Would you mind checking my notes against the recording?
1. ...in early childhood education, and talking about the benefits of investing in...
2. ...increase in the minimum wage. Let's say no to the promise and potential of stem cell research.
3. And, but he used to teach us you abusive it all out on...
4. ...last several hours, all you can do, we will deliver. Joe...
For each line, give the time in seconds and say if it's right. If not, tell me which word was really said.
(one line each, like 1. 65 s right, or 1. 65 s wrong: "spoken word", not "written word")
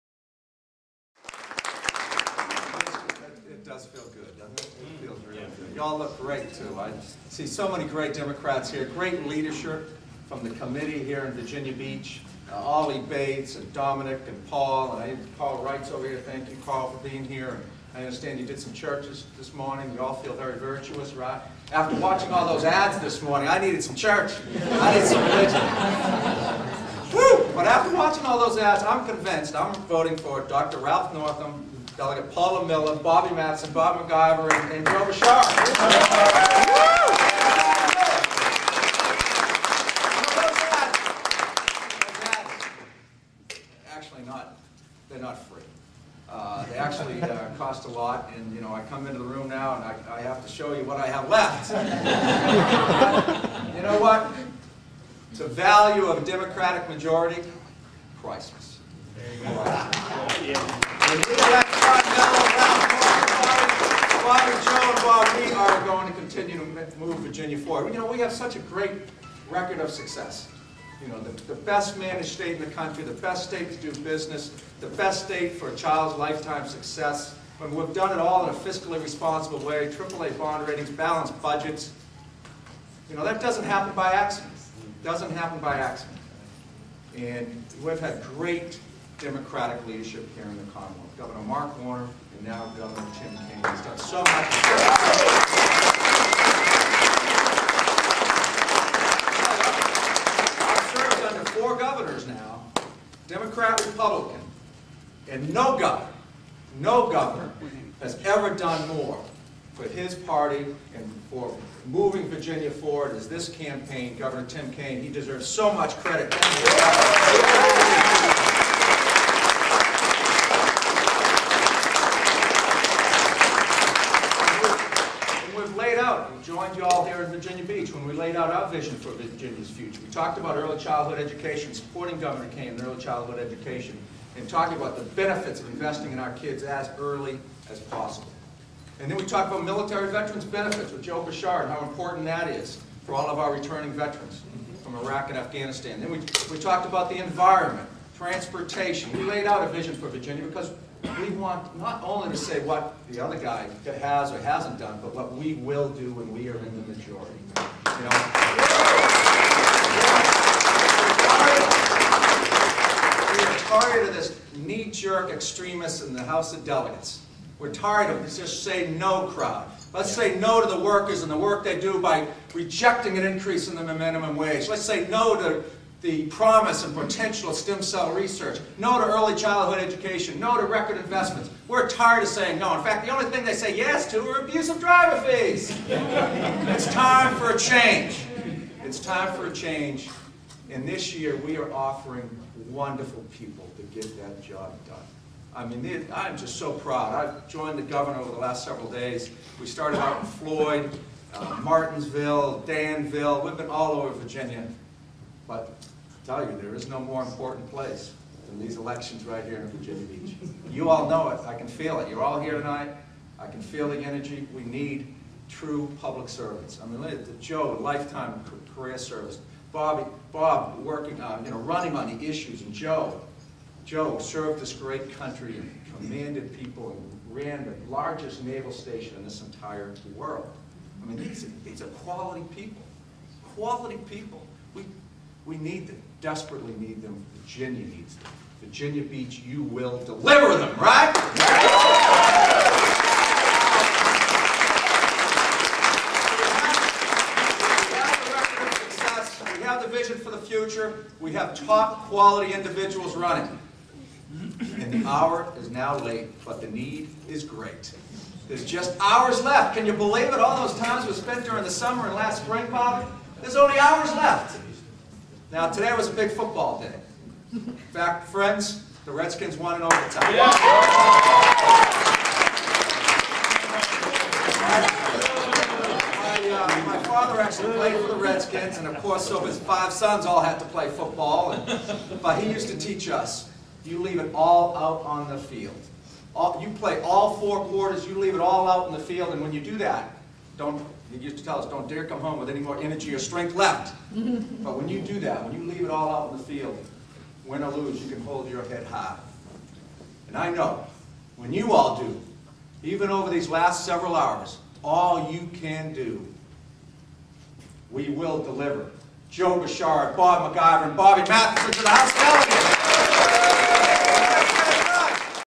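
1. 132 s right
2. 173 s right
3. 281 s wrong: "leave", not "abusive"
4. 303 s right.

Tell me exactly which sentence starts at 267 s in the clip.
In fact, friends, the Redskins won in overtime.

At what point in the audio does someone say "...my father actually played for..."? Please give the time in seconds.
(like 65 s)
276 s.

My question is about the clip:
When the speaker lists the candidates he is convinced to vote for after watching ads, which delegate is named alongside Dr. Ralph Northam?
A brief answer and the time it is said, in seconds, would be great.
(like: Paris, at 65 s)
Paula Miller, at 32 s.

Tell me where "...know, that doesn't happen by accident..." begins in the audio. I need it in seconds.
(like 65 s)
83 s.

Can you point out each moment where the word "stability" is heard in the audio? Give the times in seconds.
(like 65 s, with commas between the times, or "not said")
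not said.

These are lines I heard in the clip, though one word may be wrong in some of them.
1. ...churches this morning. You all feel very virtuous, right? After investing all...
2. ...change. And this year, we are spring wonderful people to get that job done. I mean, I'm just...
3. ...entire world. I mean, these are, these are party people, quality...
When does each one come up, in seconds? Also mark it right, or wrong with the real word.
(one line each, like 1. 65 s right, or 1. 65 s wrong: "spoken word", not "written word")
1. 18 s wrong: "watching", not "investing"
2. 189 s wrong: "offering", not "spring"
3. 229 s wrong: "quality", not "party".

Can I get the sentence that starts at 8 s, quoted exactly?
Great leadership from the committee here in Virginia Beach.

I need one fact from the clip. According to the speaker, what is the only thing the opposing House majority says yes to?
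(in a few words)
abusive driver fees.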